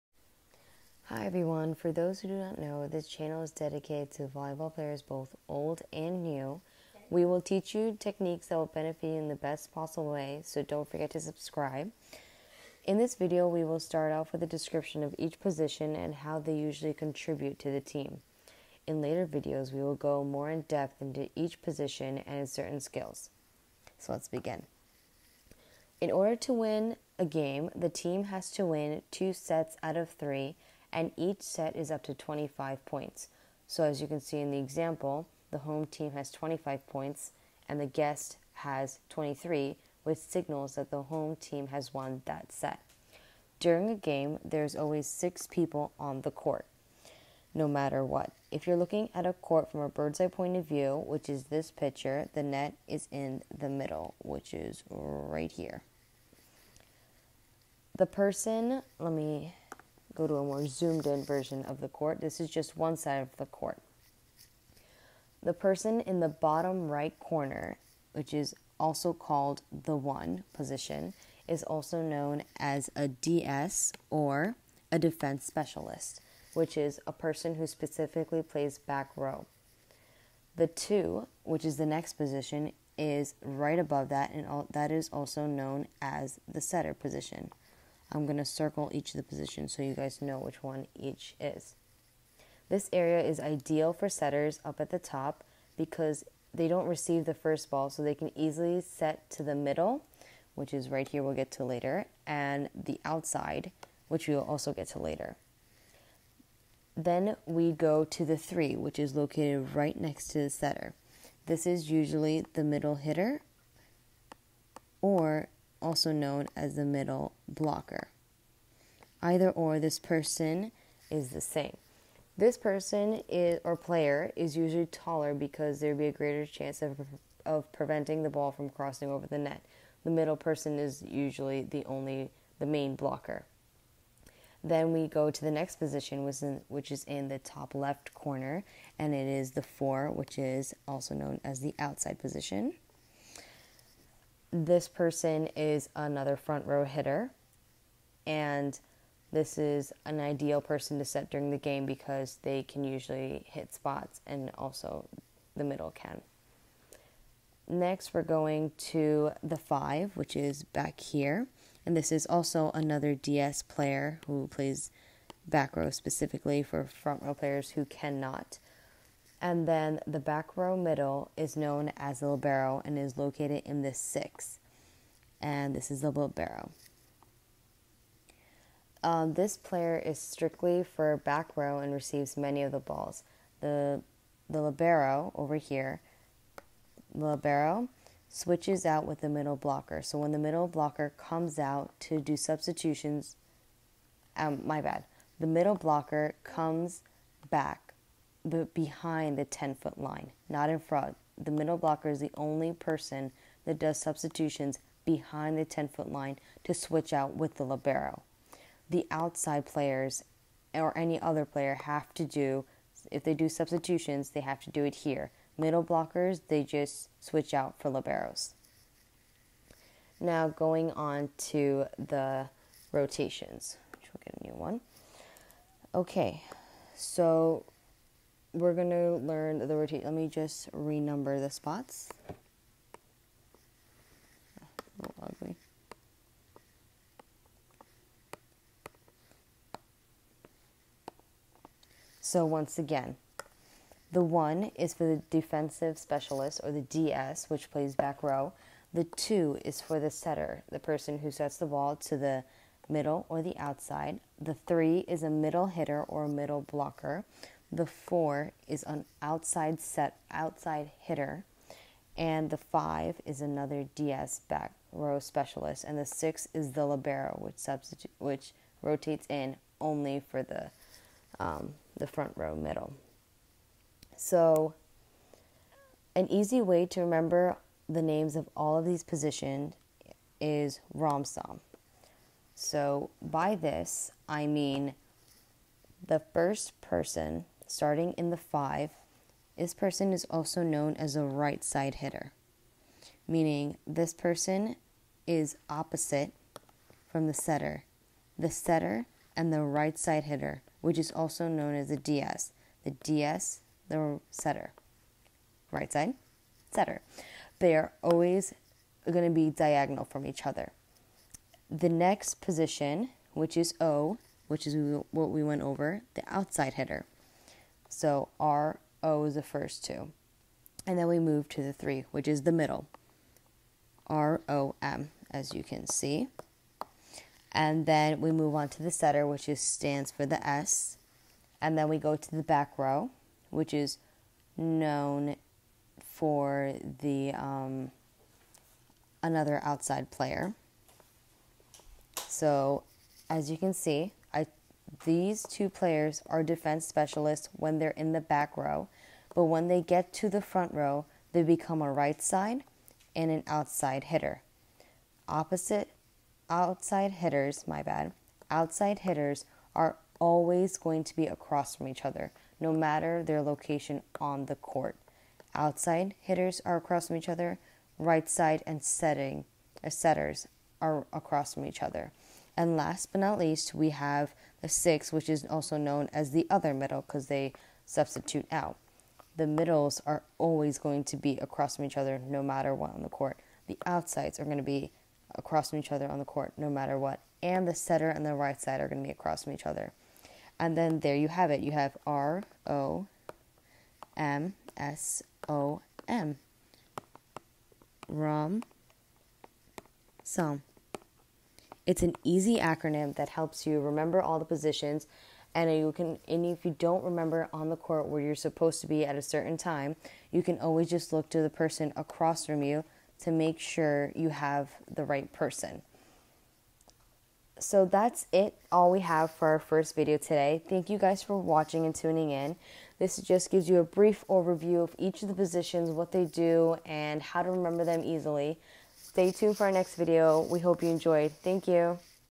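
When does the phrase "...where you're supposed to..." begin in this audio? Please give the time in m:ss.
6:48.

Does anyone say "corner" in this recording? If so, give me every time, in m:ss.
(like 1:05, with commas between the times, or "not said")
1:07, 2:18.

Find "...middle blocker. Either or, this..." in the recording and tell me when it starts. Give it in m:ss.
1:56.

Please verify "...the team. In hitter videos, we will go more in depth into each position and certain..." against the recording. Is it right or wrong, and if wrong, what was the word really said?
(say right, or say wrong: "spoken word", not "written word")
wrong: "later", not "hitter".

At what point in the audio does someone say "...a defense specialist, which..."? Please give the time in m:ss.
1:14.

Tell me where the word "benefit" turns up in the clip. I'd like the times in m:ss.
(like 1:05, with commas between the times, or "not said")
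0:08.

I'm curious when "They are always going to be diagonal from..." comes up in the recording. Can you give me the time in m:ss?
5:07.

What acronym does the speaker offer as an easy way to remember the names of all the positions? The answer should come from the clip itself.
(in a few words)
ROMSOM.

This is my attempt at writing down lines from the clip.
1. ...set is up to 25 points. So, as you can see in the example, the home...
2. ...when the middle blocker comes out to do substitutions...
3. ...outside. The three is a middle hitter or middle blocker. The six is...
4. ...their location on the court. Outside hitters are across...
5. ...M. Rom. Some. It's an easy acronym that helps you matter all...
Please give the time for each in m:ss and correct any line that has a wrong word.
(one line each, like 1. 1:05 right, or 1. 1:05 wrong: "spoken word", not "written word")
1. 0:31 right
2. 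3:10 right
3. 4:13 wrong: "four", not "six"
4. 6:03 right
5. 6:36 wrong: "remember", not "matter".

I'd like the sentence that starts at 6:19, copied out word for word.
The middles are always going to be across from each other no matter what on the court.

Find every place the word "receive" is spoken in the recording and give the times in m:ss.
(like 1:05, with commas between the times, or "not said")
1:36, 3:01.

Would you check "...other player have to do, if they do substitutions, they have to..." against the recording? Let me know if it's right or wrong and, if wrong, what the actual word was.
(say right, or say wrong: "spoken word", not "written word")
right.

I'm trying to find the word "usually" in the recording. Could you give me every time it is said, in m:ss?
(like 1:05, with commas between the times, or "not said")
0:16, 1:51, 2:04, 2:11, 2:32.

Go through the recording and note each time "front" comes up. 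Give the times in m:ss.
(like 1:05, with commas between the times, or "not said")
2:26, 2:46, 3:20, 4:32, 5:50.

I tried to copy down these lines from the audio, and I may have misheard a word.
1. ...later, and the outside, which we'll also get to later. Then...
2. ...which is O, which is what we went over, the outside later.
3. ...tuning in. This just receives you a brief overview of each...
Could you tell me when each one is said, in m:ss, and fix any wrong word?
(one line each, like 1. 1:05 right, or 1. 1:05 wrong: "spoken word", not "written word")
1. 1:41 right
2. 5:13 wrong: "hitter", not "later"
3. 7:01 wrong: "gives", not "receives".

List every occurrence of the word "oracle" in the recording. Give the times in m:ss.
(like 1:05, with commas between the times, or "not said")
not said.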